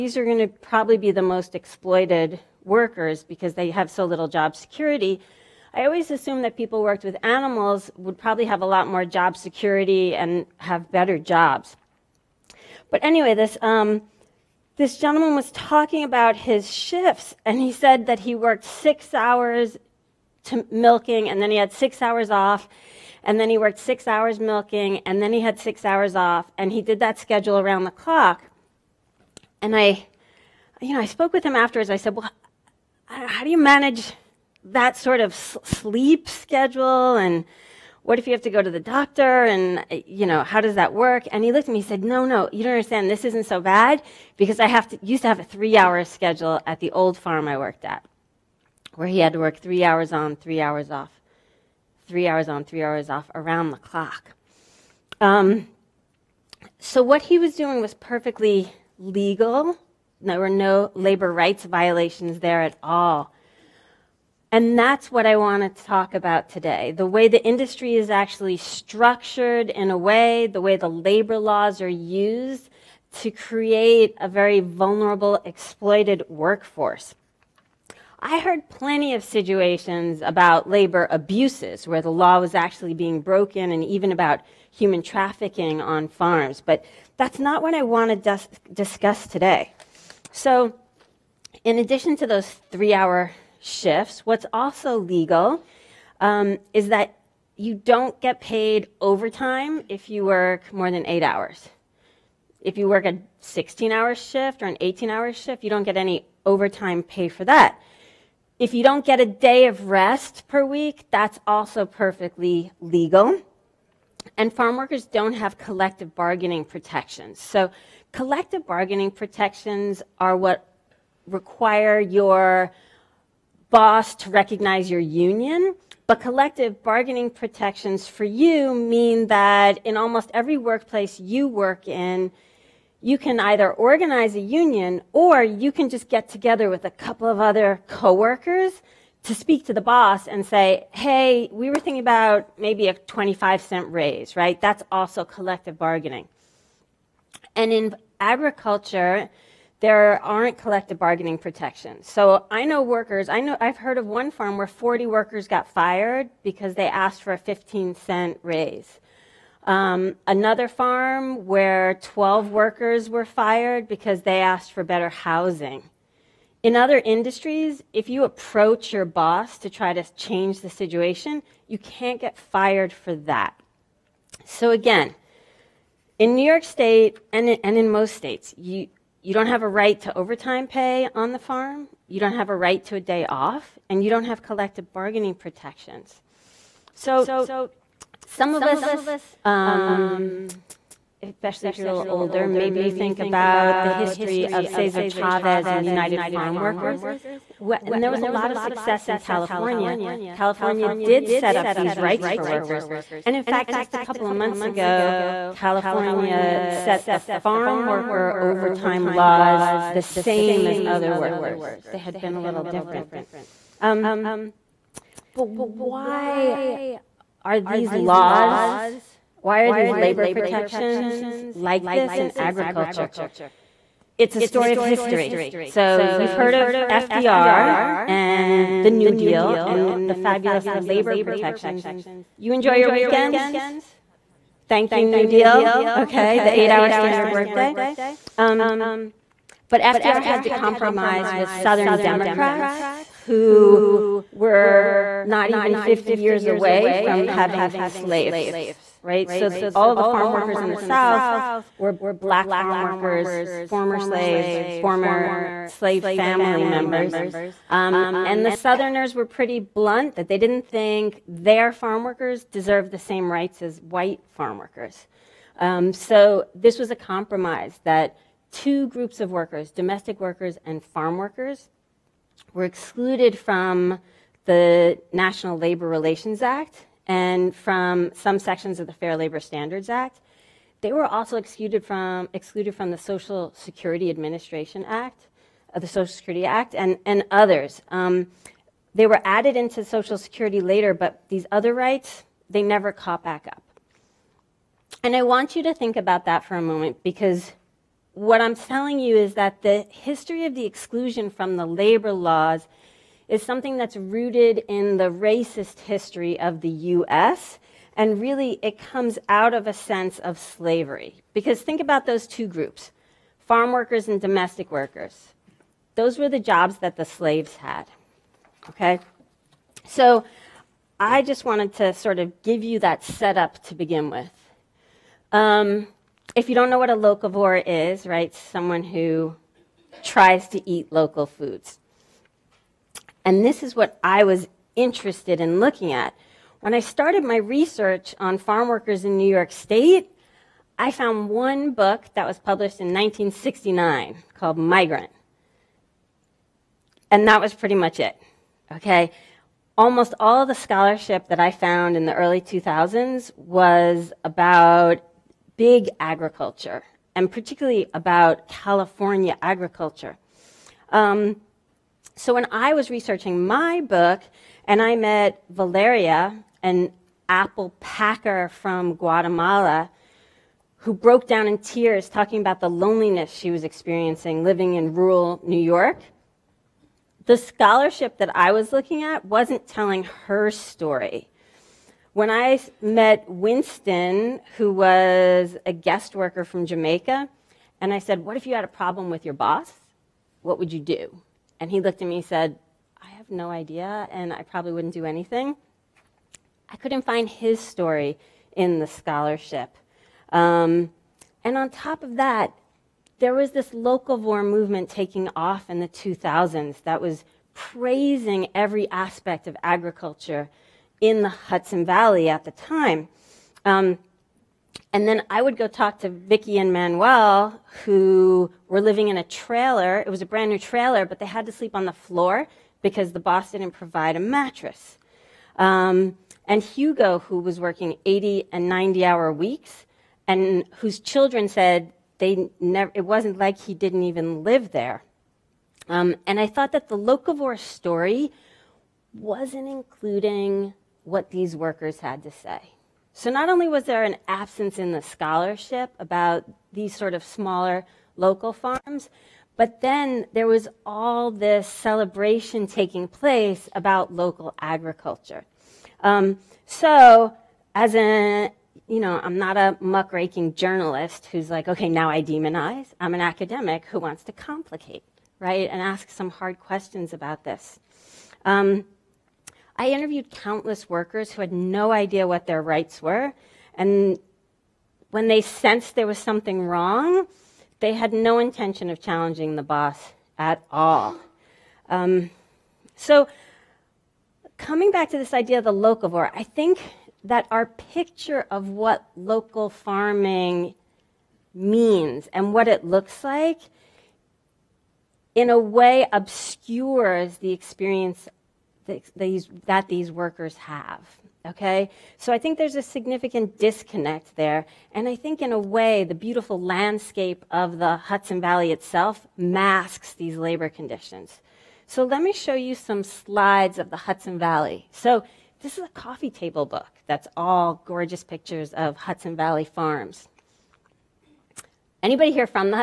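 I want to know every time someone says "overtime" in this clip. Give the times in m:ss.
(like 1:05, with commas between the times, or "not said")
1:39, 1:46, 3:00, 3:28.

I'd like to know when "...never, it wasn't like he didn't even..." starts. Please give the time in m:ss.
7:12.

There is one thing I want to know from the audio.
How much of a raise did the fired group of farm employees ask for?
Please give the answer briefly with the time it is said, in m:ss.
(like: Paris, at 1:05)
15 cents, at 2:37.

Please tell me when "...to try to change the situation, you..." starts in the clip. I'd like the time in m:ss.
2:49.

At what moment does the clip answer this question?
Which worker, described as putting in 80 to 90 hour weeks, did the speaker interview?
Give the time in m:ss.
7:06.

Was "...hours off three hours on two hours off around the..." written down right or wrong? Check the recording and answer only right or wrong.
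wrong.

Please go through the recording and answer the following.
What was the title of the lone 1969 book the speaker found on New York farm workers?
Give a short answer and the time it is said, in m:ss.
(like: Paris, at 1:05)
Migrant, at 5:44.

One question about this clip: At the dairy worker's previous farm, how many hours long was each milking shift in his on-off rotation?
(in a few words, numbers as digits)
3.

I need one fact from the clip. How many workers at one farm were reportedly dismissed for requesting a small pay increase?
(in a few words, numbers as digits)
40.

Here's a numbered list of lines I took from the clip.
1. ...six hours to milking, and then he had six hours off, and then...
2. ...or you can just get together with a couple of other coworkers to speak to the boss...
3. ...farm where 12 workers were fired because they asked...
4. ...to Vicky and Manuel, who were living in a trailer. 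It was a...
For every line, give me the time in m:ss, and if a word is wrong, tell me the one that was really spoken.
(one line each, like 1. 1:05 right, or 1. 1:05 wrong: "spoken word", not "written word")
1. 0:18 right
2. 2:15 right
3. 2:40 right
4. 6:56 right.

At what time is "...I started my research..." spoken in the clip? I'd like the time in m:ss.
5:36.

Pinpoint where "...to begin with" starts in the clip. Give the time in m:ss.
5:23.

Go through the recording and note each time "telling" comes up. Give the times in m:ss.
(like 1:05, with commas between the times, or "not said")
4:58, 6:19.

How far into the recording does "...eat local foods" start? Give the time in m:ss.
5:30.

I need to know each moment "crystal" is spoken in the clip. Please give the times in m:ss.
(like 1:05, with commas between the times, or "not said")
not said.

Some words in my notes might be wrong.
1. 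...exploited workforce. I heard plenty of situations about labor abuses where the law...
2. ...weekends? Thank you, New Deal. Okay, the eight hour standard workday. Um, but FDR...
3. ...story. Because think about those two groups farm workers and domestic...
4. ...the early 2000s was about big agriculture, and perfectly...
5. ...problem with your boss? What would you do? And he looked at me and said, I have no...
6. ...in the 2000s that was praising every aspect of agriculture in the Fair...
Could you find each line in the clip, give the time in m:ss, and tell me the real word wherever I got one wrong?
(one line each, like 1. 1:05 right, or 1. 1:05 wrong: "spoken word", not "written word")
1. 1:15 right
2. 3:52 right
3. 5:10 wrong: "slavery", not "story"
4. 5:52 wrong: "particularly", not "perfectly"
5. 6:28 right
6. 6:45 wrong: "Hudson", not "Fair".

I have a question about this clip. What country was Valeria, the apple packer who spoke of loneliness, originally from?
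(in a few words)
Guatemala.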